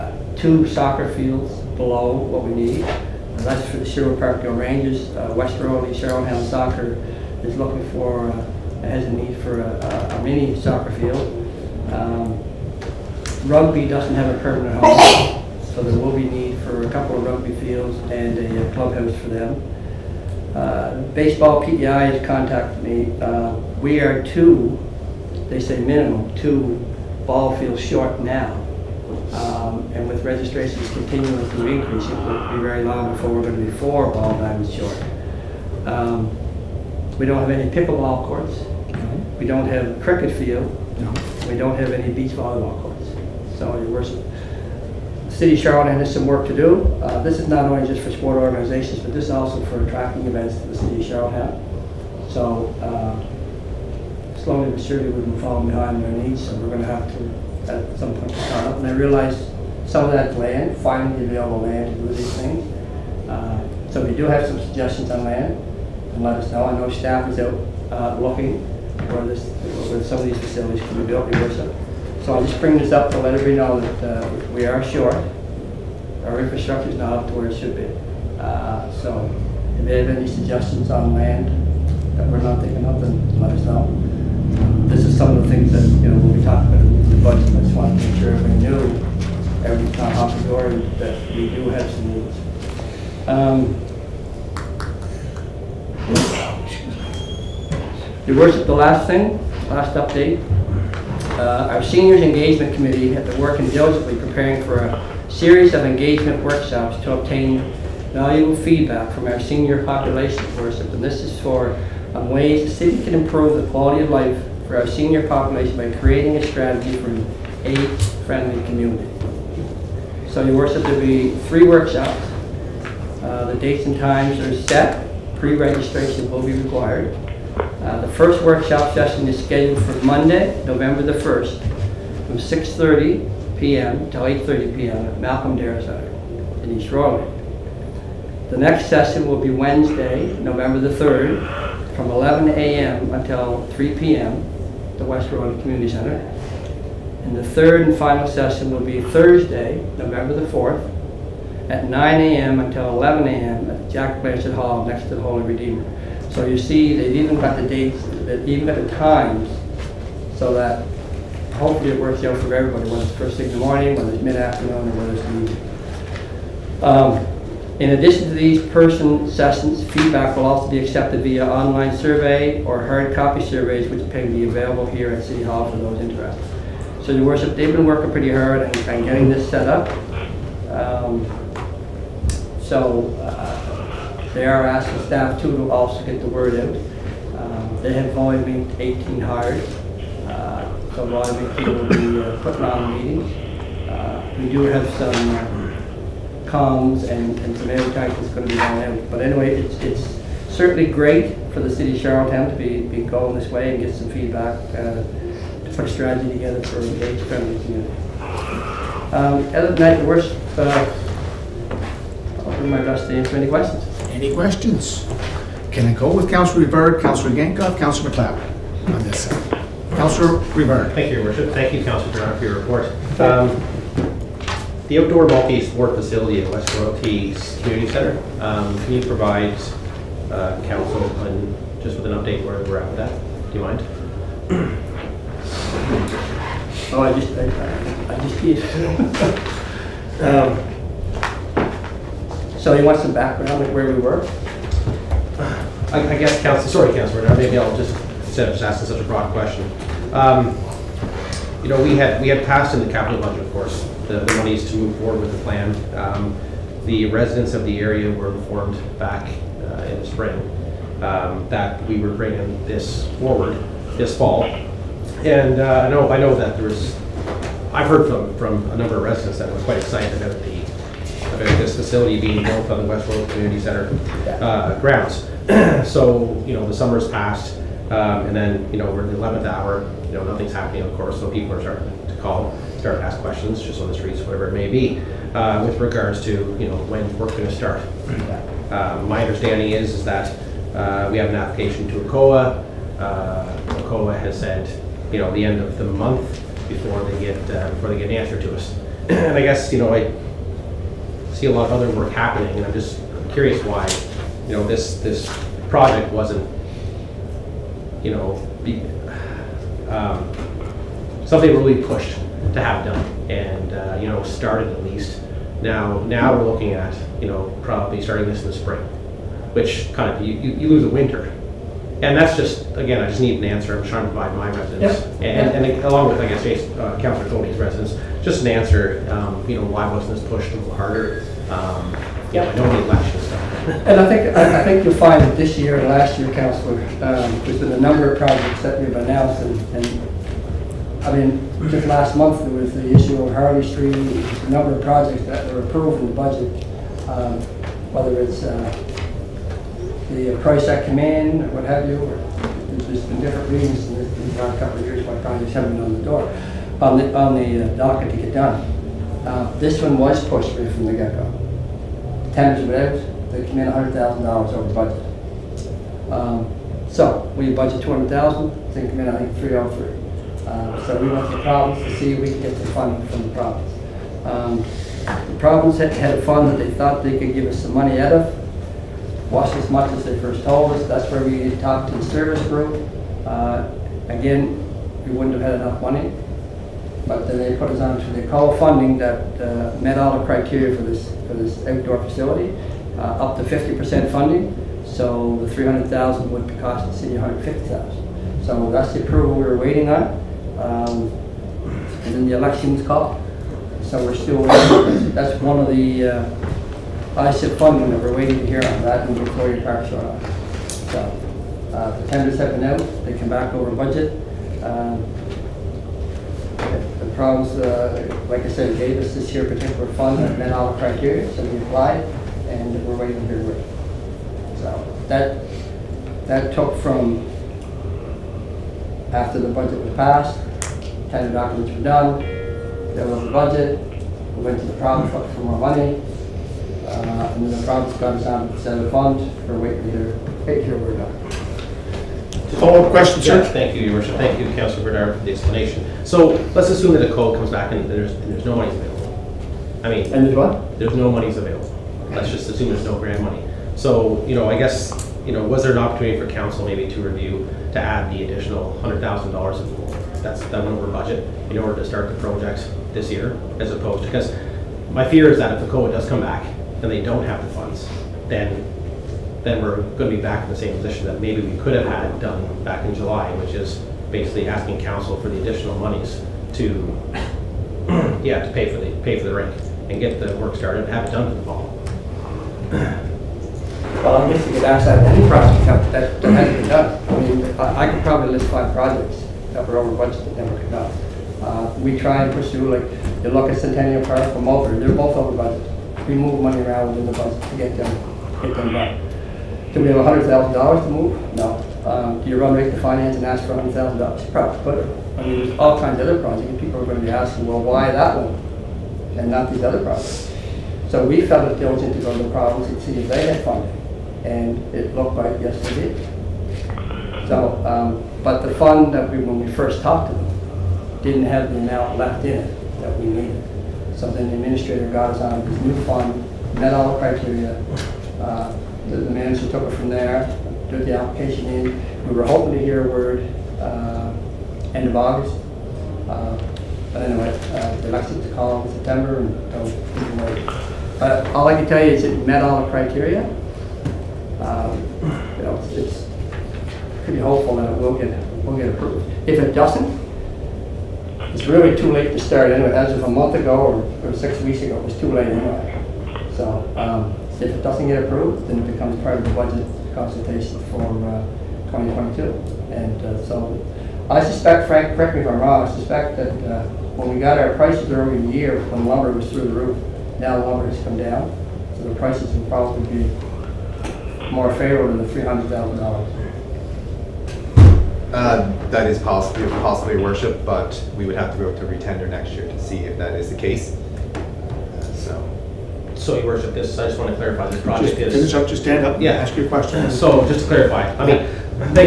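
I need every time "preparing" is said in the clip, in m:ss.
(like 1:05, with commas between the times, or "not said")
1:44.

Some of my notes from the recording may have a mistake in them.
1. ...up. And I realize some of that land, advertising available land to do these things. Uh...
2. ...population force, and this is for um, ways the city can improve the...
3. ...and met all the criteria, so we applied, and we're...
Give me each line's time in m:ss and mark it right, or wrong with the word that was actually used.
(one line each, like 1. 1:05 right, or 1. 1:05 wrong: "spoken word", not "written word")
1. 0:58 wrong: "finding", not "advertising"
2. 1:49 right
3. 7:00 right.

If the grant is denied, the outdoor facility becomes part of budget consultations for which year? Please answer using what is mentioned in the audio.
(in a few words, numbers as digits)
2022.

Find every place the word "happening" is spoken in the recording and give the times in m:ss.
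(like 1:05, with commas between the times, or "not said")
4:40, 5:02.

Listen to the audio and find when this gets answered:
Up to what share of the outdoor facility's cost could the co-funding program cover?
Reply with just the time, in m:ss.
6:33.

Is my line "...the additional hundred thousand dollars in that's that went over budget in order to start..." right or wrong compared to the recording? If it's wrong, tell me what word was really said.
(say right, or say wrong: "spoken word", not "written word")
right.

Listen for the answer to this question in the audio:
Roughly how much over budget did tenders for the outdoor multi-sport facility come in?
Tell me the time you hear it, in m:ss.
6:03.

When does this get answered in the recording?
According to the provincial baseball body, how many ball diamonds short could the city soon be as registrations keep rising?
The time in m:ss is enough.
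0:33.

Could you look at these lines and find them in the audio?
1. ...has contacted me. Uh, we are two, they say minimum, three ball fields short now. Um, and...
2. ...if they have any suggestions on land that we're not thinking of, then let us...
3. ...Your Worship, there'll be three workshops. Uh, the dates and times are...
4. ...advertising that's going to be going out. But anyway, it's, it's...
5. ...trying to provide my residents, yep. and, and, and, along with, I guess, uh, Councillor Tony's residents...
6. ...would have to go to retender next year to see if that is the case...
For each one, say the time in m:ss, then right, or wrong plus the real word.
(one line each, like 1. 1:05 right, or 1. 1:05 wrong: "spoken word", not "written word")
1. 0:22 wrong: "two", not "three"
2. 1:19 right
3. 2:00 right
4. 3:17 right
5. 5:23 right
6. 9:41 right.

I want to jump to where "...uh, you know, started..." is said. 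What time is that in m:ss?
5:13.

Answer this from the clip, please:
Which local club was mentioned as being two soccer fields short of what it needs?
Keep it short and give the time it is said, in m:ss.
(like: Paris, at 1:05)
Sherwood Parkdale Rangers, at 0:03.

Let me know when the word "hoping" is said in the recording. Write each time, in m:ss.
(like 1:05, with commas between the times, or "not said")
8:52.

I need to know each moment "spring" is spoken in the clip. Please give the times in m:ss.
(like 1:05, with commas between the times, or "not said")
4:20, 5:18.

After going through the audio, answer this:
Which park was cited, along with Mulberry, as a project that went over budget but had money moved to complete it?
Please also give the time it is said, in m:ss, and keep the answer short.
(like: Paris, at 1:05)
Centennial Park, at 8:13.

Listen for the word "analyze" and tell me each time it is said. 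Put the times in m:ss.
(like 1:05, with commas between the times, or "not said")
not said.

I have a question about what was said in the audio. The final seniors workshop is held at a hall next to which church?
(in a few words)
Holy Redeemer.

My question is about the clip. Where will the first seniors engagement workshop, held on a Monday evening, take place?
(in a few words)
Malcolm Darrach.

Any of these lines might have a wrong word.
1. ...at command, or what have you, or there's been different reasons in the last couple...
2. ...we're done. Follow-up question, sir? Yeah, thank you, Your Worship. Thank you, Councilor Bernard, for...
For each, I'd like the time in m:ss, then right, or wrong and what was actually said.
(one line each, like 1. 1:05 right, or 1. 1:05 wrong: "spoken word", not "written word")
1. 5:50 right
2. 7:20 right.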